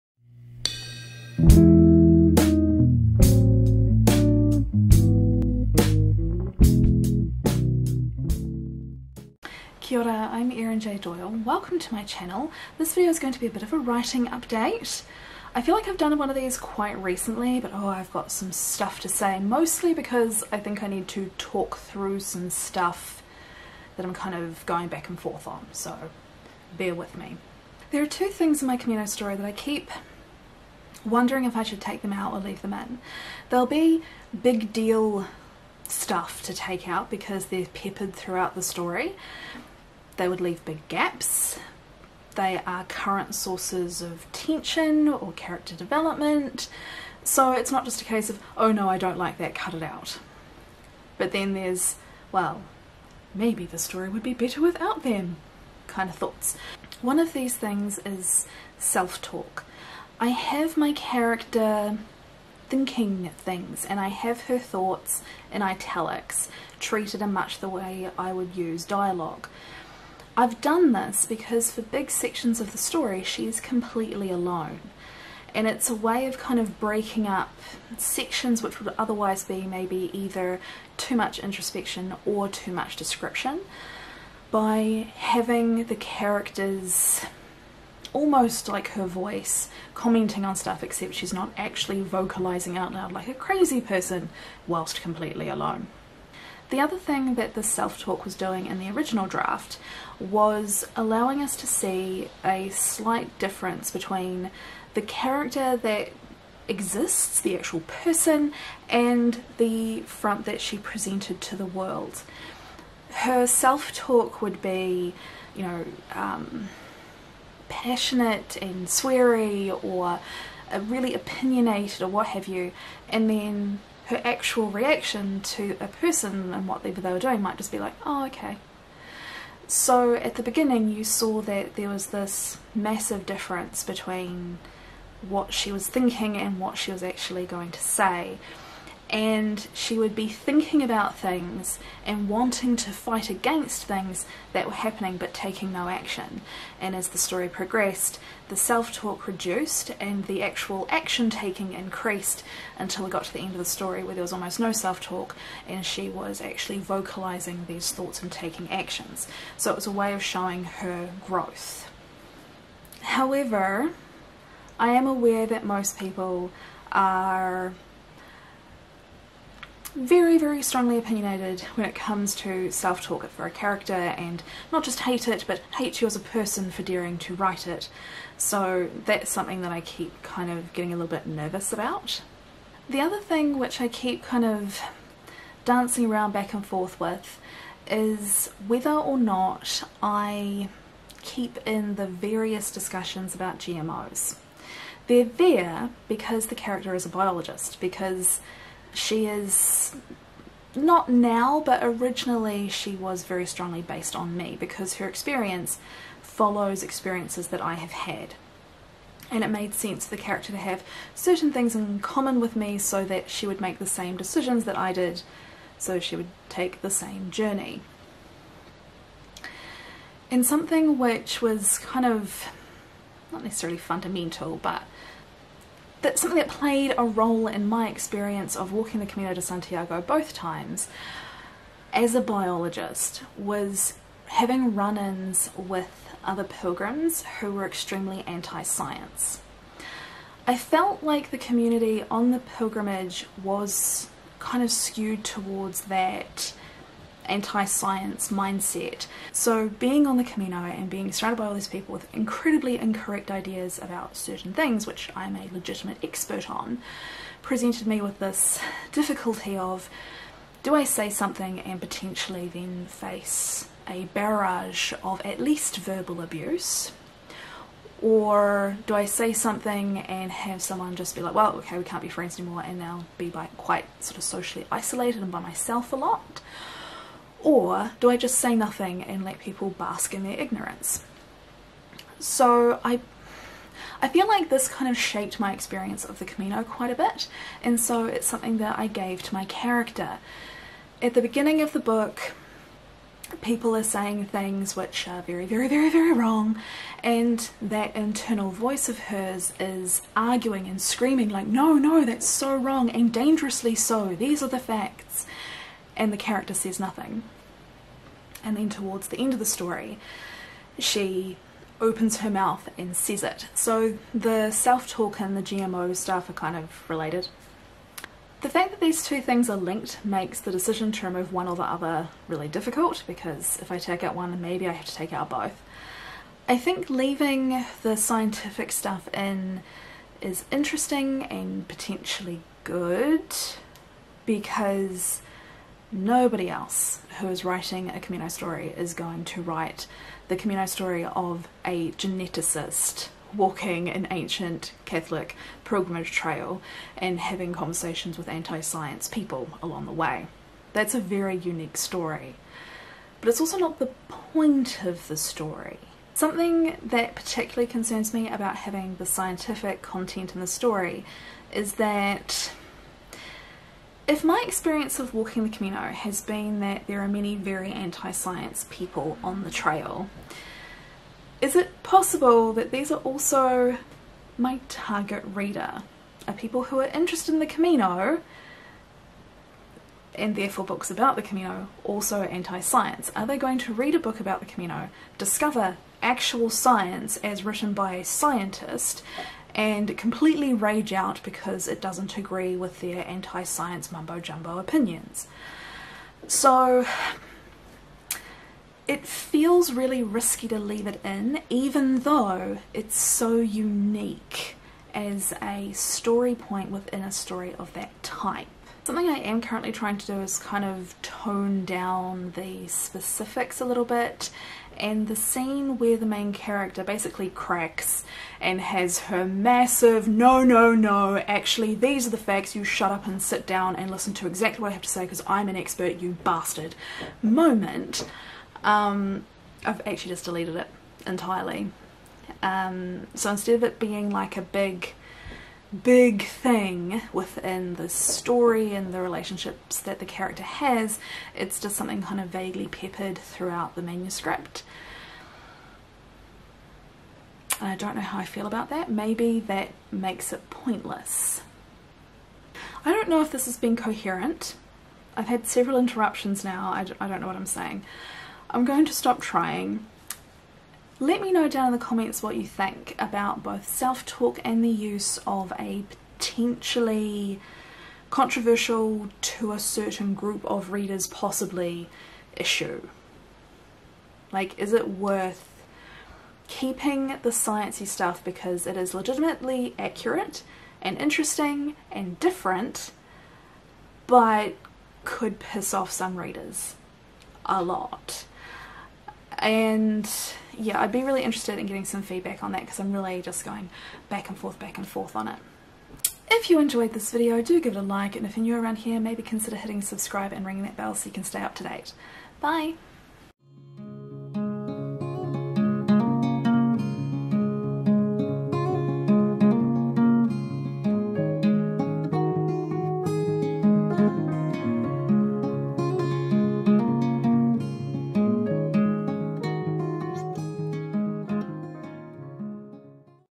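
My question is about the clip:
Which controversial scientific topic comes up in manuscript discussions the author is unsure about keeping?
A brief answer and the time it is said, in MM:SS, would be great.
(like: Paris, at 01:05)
GMOs, at 03:13.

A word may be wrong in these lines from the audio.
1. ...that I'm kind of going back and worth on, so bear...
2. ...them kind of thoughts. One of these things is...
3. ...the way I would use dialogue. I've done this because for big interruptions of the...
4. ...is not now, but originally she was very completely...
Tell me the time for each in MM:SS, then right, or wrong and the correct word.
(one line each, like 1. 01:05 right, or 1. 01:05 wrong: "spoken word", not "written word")
1. 00:23 wrong: "forth", not "worth"
2. 00:55 right
3. 01:07 wrong: "sections", not "interruptions"
4. 03:19 wrong: "strongly", not "completely".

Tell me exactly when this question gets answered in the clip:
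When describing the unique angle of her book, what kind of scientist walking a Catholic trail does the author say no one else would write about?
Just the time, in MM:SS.
05:41.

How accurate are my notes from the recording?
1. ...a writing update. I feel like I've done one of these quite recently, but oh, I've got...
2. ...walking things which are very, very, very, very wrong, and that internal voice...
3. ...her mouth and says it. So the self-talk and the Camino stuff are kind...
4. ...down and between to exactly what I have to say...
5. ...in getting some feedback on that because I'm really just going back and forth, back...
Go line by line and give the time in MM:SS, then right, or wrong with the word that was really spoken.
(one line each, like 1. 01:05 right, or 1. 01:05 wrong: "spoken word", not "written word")
1. 00:13 right
2. 04:53 wrong: "saying", not "walking"
3. 05:12 wrong: "GMO", not "Camino"
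4. 07:03 wrong: "listen", not "between"
5. 08:11 right.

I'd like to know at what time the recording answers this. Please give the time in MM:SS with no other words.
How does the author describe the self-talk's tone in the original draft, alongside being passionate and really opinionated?
01:58.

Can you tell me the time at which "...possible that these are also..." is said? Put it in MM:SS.
06:11.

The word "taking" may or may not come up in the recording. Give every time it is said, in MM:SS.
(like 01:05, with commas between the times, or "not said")
02:25, 02:31, 02:38.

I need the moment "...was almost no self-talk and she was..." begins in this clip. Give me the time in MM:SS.
02:34.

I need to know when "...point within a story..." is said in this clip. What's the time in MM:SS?
06:46.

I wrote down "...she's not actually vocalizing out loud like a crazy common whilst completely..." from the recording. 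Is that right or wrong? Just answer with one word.
wrong.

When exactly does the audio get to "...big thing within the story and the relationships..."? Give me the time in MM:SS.
07:15.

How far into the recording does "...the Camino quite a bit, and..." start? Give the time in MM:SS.
04:46.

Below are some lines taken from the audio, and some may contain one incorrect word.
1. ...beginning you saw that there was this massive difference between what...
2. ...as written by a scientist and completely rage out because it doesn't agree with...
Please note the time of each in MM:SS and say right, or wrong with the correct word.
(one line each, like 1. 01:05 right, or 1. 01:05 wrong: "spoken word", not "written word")
1. 02:10 right
2. 06:27 right.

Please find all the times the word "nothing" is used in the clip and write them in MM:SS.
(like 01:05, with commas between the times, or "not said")
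04:38, 05:06.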